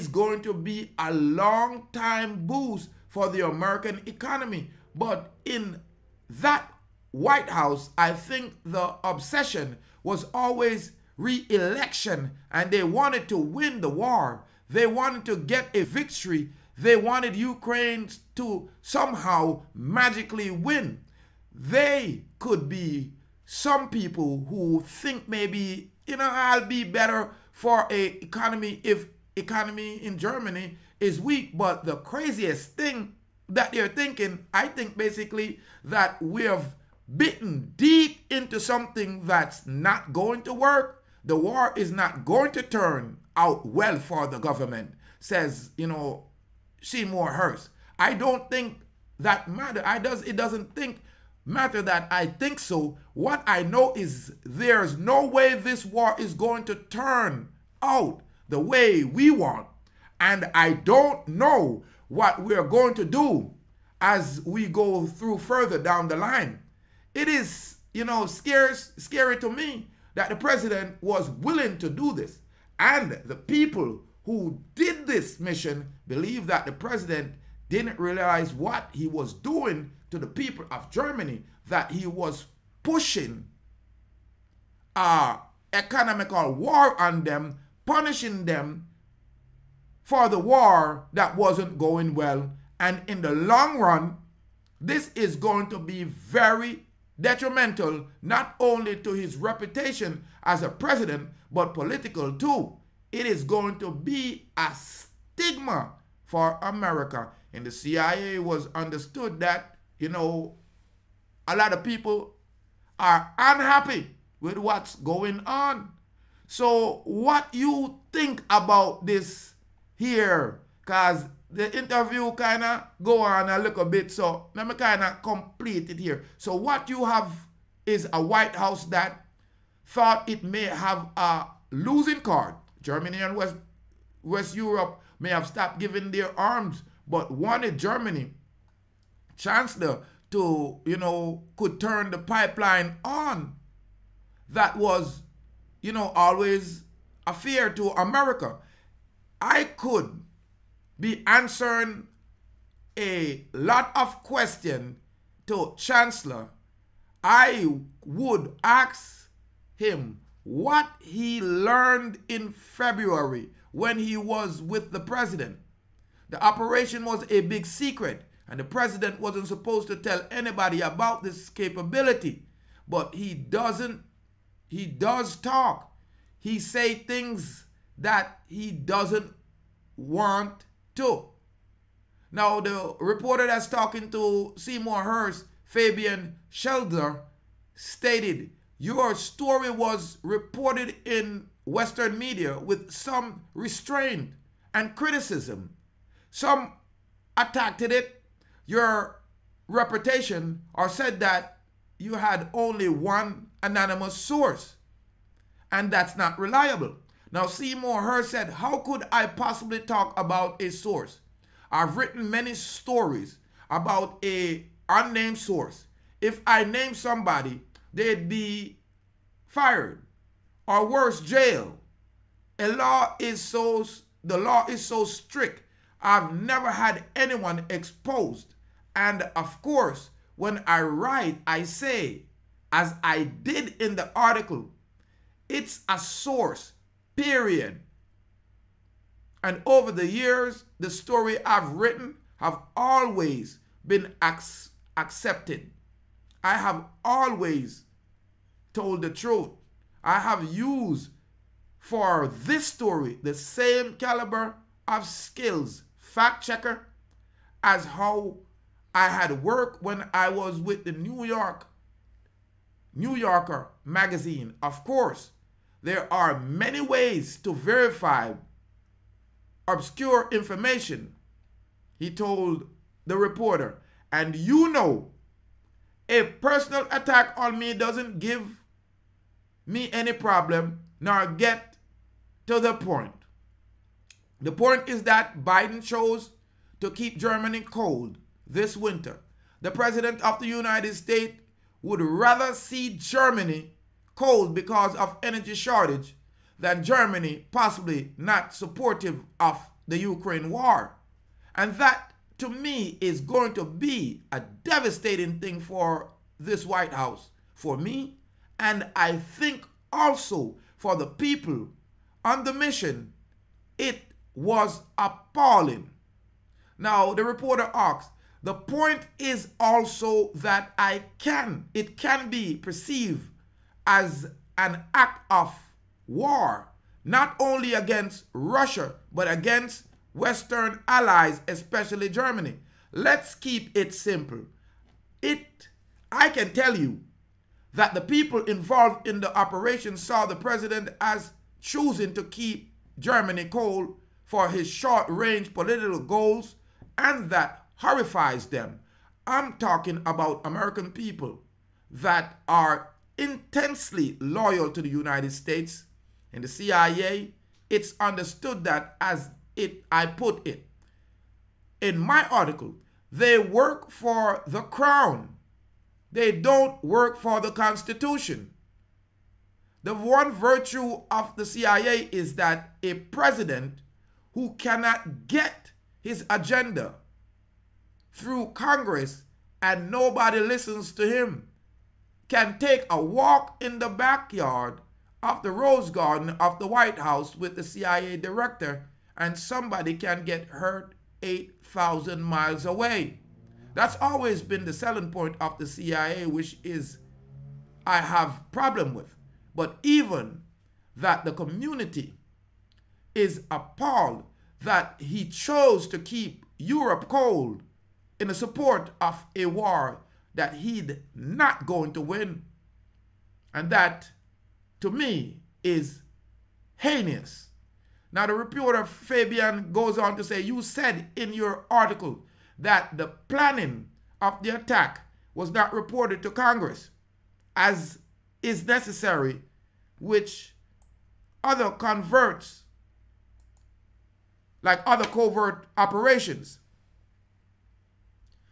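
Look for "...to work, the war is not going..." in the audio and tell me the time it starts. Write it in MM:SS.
00:40.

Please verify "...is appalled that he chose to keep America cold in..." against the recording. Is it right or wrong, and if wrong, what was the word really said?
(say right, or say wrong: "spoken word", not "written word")
wrong: "Europe", not "America".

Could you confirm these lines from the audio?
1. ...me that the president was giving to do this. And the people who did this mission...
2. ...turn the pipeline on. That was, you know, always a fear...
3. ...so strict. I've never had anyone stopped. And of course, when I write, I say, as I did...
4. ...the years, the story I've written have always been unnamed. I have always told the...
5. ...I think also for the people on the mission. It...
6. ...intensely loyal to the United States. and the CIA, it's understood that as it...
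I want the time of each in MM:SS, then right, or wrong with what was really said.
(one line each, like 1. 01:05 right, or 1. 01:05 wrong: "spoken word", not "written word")
1. 01:09 wrong: "willing", not "giving"
2. 02:21 right
3. 03:44 wrong: "exposed", not "stopped"
4. 03:59 wrong: "accepted", not "unnamed"
5. 05:08 right
6. 05:53 right.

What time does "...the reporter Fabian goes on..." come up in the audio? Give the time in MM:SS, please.
06:58.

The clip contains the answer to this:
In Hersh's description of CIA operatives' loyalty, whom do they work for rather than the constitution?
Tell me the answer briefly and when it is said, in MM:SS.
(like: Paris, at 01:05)
The crown, at 06:04.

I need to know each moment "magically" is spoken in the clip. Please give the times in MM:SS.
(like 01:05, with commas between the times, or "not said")
00:19.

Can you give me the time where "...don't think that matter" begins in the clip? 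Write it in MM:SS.
00:48.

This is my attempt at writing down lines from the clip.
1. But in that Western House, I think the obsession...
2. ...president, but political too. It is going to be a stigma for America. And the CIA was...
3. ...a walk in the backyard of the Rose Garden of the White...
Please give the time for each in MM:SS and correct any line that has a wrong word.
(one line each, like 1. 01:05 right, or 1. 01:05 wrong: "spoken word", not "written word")
1. 00:04 wrong: "White", not "Western"
2. 01:40 right
3. 06:22 right.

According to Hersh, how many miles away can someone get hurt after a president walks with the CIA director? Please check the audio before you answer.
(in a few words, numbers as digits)
8,000 miles.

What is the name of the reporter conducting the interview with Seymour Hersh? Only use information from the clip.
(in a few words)
Fabian Scheidler.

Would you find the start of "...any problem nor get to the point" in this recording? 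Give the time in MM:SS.
04:39.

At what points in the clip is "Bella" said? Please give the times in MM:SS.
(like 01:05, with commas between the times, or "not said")
not said.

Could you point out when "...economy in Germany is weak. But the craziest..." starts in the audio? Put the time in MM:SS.
00:29.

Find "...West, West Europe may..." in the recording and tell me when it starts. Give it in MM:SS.
02:13.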